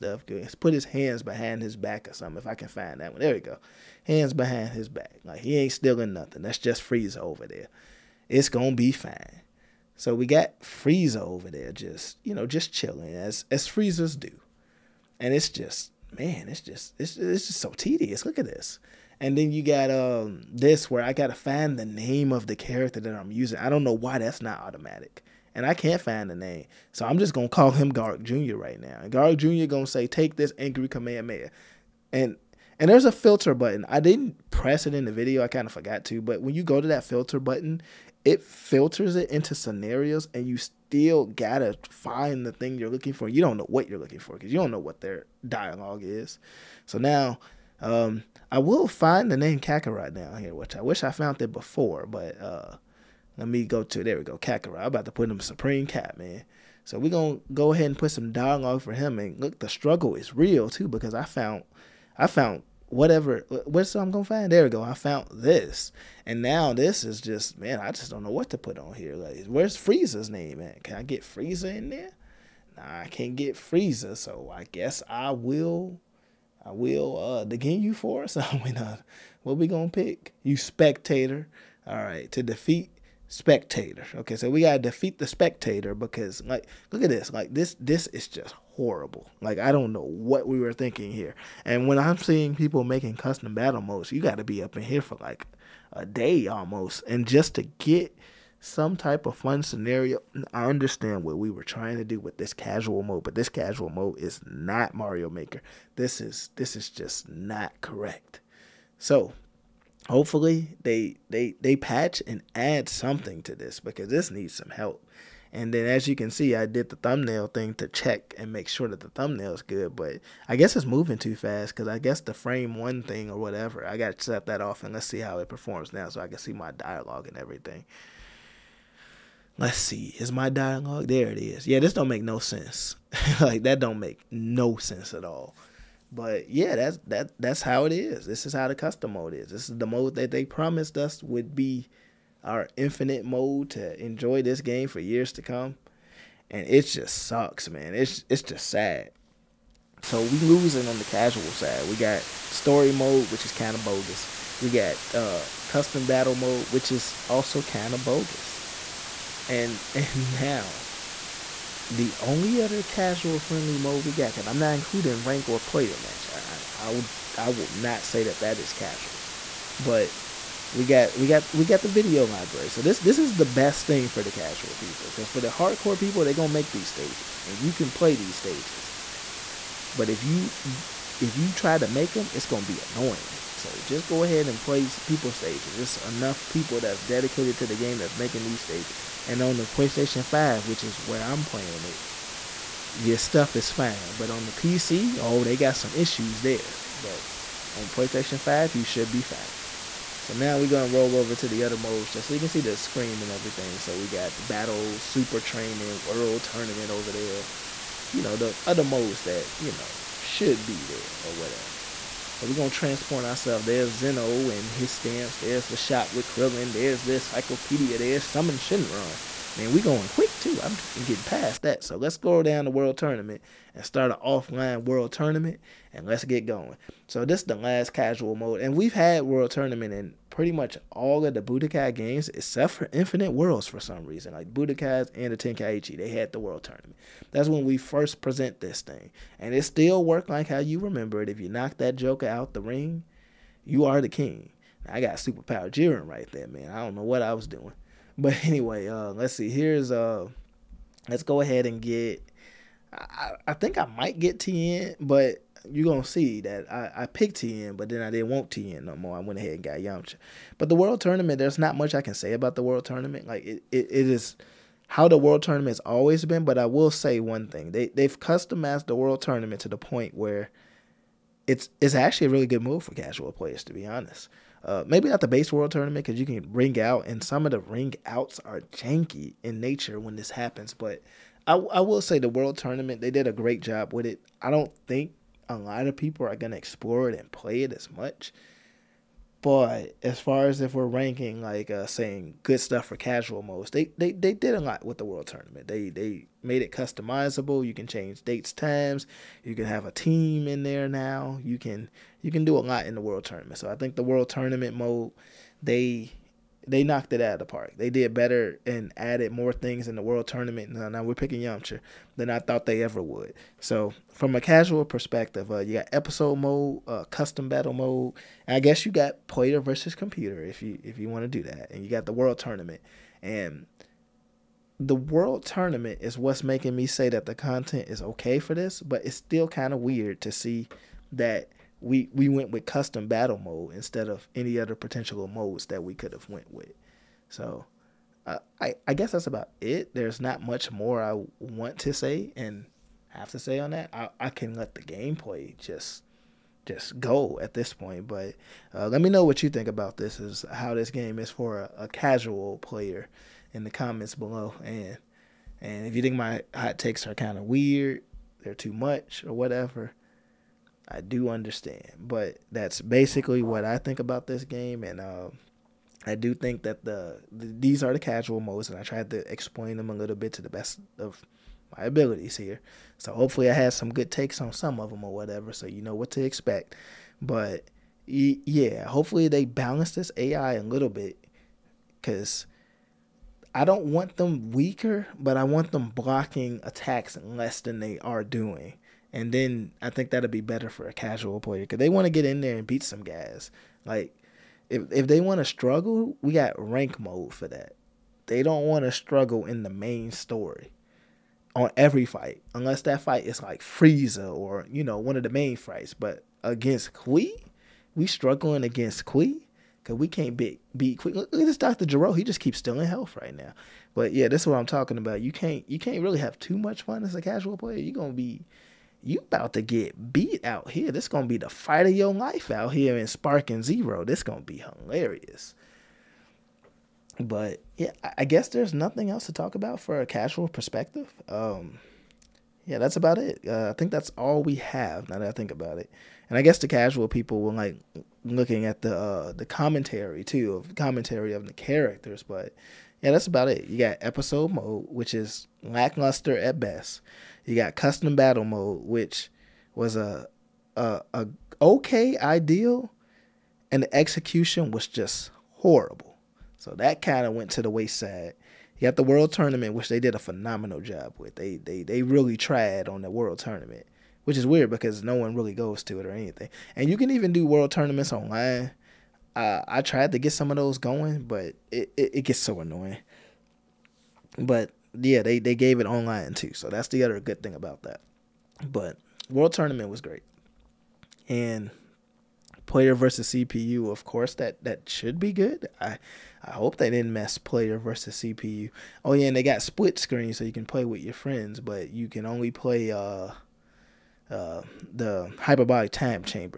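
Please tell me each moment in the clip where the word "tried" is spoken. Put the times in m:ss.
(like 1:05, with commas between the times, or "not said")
6:08, 7:42, 7:49.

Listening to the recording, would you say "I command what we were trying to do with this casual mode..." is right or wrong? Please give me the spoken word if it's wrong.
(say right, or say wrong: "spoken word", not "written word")
wrong: "understand", not "command".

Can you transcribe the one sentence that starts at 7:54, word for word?
But yeah, they they gave it online too.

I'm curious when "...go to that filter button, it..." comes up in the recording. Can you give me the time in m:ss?
0:36.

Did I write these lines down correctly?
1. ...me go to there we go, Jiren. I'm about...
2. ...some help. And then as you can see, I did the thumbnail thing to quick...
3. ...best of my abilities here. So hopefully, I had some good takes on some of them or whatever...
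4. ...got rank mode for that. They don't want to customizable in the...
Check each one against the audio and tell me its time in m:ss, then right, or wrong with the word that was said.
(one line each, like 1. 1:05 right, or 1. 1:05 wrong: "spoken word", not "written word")
1. 0:53 wrong: "Kakarot", not "Jiren"
2. 1:54 wrong: "check", not "quick"
3. 6:10 right
4. 6:36 wrong: "struggle", not "customizable".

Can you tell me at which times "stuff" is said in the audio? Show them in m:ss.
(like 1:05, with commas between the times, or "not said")
3:13, 4:52.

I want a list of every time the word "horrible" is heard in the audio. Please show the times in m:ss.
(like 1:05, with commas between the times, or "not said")
1:28, 7:35.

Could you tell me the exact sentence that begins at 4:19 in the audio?
I went ahead and got Yamcha.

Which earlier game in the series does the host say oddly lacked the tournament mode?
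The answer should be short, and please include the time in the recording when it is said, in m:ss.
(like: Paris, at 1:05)
Infinite Worlds, at 3:52.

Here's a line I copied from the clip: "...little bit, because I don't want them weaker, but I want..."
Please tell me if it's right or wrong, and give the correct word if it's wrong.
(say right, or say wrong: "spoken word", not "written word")
right.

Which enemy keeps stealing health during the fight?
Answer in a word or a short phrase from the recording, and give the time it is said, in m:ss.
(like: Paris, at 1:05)
Doctor Gero, at 6:51.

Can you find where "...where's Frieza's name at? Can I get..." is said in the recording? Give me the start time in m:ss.
1:09.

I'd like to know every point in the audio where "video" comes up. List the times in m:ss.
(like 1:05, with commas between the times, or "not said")
0:35, 2:51.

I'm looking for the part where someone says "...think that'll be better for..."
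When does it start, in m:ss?
6:29.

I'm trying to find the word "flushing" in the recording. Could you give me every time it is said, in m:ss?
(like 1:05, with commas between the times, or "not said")
not said.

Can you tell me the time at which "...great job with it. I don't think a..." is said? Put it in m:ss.
4:43.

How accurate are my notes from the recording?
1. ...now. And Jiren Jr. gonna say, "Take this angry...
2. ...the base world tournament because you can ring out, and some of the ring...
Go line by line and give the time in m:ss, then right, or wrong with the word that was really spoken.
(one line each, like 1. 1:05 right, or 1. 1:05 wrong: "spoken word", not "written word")
1. 0:28 wrong: "Garg", not "Jiren"
2. 4:35 right.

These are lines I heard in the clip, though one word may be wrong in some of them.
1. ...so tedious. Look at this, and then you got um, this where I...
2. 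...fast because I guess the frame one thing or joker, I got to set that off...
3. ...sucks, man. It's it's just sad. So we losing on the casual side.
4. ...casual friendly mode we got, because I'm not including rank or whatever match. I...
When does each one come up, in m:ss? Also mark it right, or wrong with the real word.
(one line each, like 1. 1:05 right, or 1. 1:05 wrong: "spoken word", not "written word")
1. 0:17 right
2. 2:01 wrong: "whatever", not "joker"
3. 2:27 right
4. 2:42 wrong: "player", not "whatever".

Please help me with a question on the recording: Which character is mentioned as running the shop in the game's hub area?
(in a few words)
Krillin.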